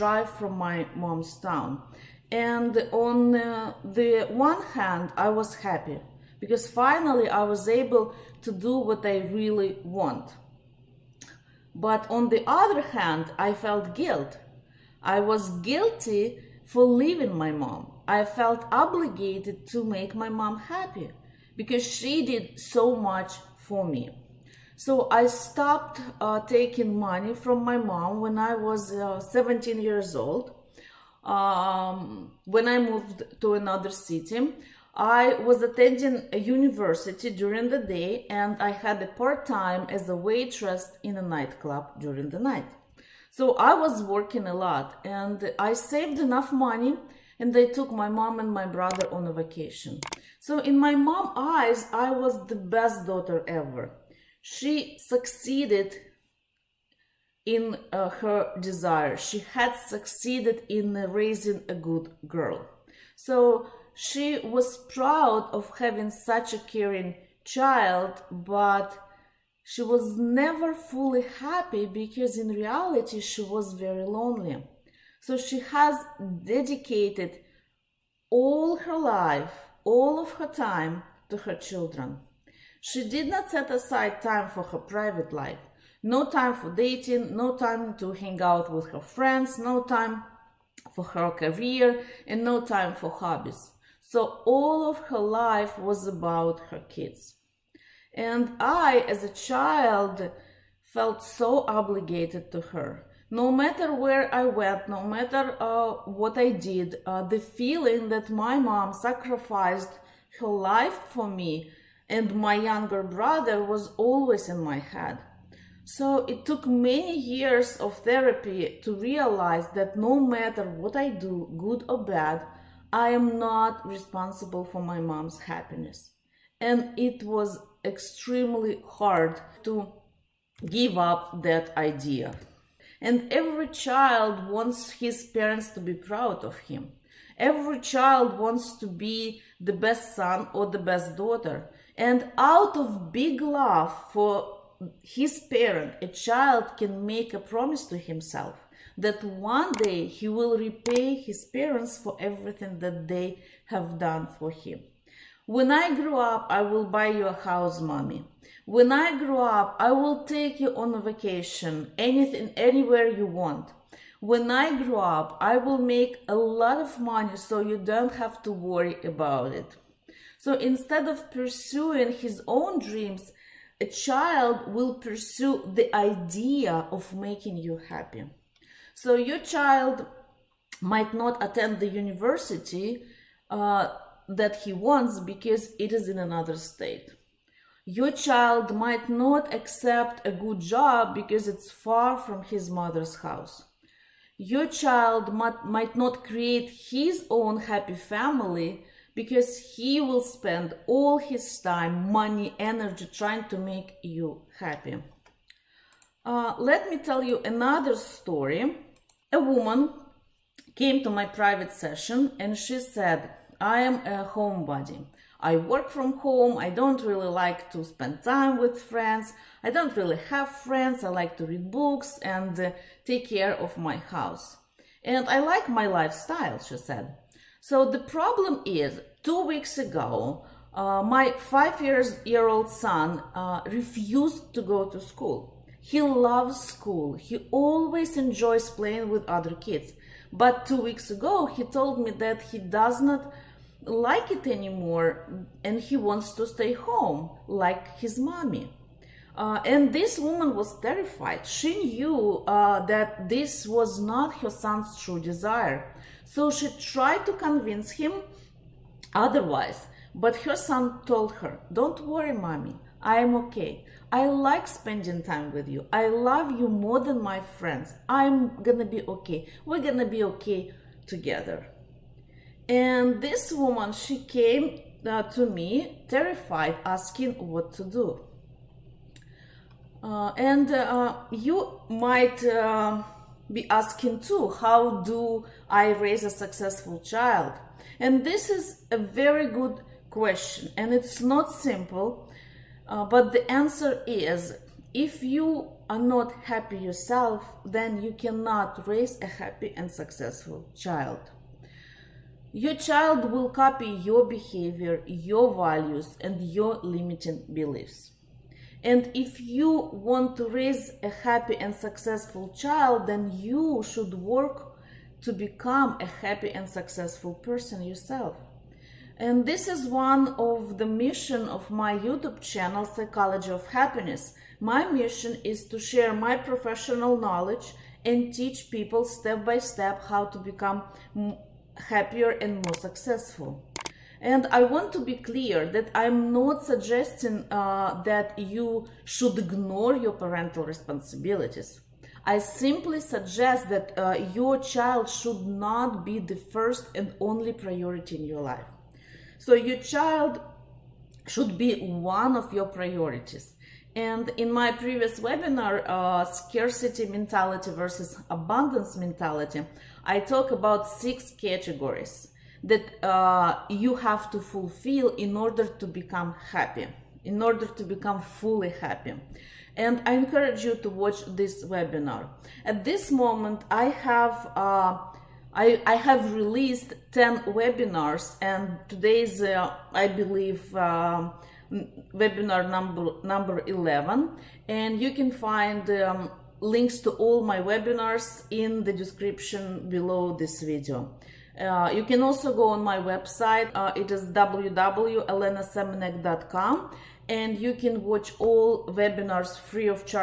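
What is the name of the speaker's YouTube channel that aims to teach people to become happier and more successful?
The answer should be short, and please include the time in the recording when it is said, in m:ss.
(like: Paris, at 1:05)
Psychology of Happiness, at 5:22.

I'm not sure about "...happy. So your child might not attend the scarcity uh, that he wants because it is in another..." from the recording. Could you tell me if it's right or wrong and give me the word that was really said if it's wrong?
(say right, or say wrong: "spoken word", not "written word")
wrong: "university", not "scarcity".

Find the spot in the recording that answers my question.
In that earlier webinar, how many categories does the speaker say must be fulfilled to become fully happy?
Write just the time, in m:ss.
6:00.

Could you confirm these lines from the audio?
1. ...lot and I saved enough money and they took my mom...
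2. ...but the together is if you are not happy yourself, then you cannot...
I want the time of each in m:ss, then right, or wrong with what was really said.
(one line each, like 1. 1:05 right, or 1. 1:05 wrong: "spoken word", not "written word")
1. 0:44 right
2. 4:53 wrong: "answer", not "together".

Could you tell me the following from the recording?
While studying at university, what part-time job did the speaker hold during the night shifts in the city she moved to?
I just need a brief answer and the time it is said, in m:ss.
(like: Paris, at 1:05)
Waitress in a nightclub, at 0:40.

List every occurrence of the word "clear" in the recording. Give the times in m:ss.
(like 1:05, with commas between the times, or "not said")
5:35.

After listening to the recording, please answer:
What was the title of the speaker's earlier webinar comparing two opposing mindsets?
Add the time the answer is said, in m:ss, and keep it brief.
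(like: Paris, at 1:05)
Scarcity mentality versus abundance mentality, at 5:56.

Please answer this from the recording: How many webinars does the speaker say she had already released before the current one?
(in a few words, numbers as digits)
10.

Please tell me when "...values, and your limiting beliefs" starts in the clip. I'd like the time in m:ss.
5:05.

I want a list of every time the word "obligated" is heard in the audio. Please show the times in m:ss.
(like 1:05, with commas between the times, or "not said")
0:18, 1:41.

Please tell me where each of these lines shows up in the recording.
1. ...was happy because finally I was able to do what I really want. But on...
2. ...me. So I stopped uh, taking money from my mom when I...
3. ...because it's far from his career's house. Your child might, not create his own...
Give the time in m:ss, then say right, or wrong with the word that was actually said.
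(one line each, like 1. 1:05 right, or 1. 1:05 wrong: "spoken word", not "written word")
1. 0:05 right
2. 0:23 right
3. 3:11 wrong: "mother", not "career".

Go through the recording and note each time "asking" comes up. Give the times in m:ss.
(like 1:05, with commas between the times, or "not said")
4:36, 4:43.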